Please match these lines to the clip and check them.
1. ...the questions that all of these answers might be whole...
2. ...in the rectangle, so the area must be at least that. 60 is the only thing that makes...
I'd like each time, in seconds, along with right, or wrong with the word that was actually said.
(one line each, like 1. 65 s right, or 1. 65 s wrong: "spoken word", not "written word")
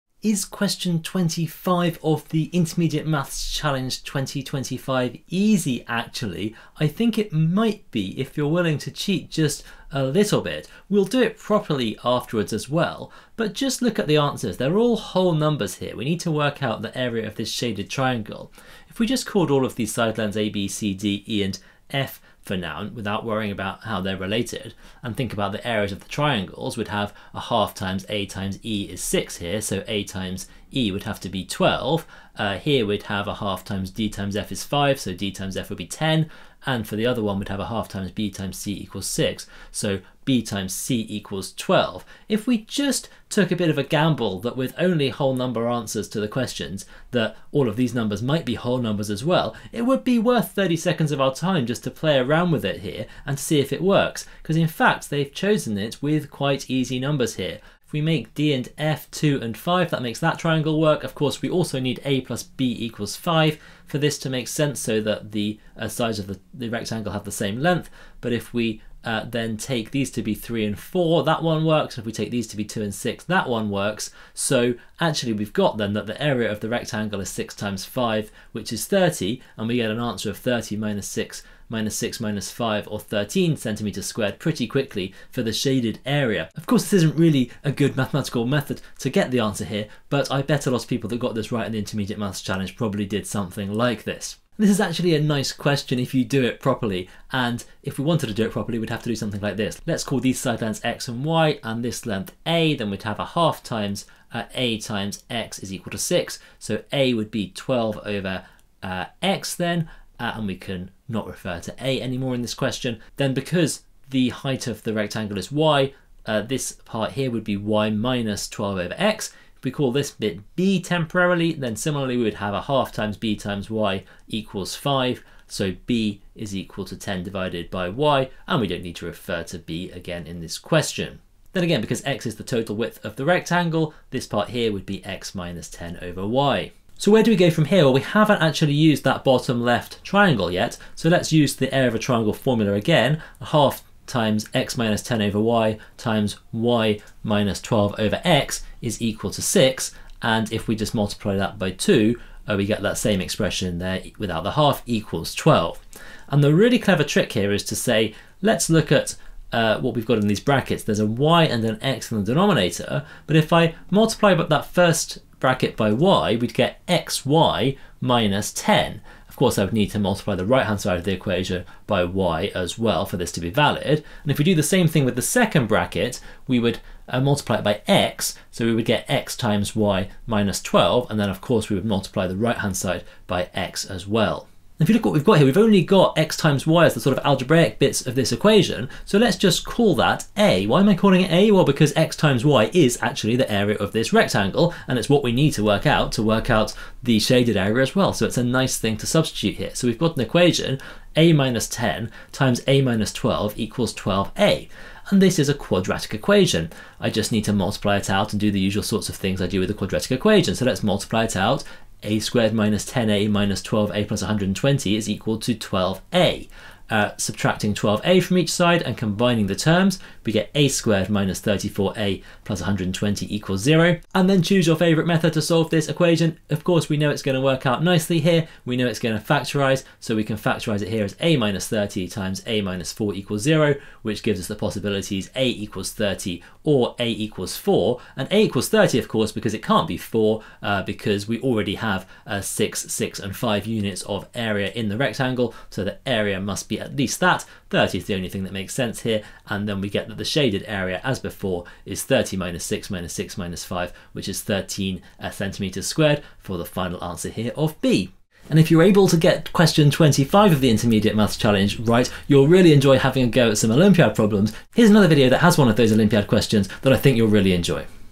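1. 46 s wrong: "numbers", not "answers"
2. 244 s wrong: "30", not "60".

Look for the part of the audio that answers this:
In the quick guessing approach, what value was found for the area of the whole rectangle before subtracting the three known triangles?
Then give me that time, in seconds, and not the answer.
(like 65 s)
77 s.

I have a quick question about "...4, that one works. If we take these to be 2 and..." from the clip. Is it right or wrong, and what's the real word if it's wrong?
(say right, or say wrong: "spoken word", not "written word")
right.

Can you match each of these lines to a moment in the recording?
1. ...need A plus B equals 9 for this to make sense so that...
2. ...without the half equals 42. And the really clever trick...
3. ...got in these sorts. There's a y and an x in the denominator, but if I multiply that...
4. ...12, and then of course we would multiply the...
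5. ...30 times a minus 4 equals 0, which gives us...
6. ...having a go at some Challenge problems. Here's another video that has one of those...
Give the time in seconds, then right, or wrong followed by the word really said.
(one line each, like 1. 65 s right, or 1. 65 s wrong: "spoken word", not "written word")
1. 61 s wrong: "5", not "9"
2. 154 s wrong: "12", not "42"
3. 160 s wrong: "brackets", not "sorts"
4. 180 s right
5. 231 s right
6. 262 s wrong: "Olympiad", not "Challenge".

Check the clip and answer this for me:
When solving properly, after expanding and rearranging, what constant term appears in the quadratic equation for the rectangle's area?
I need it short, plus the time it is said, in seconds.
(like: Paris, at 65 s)
120, at 220 s.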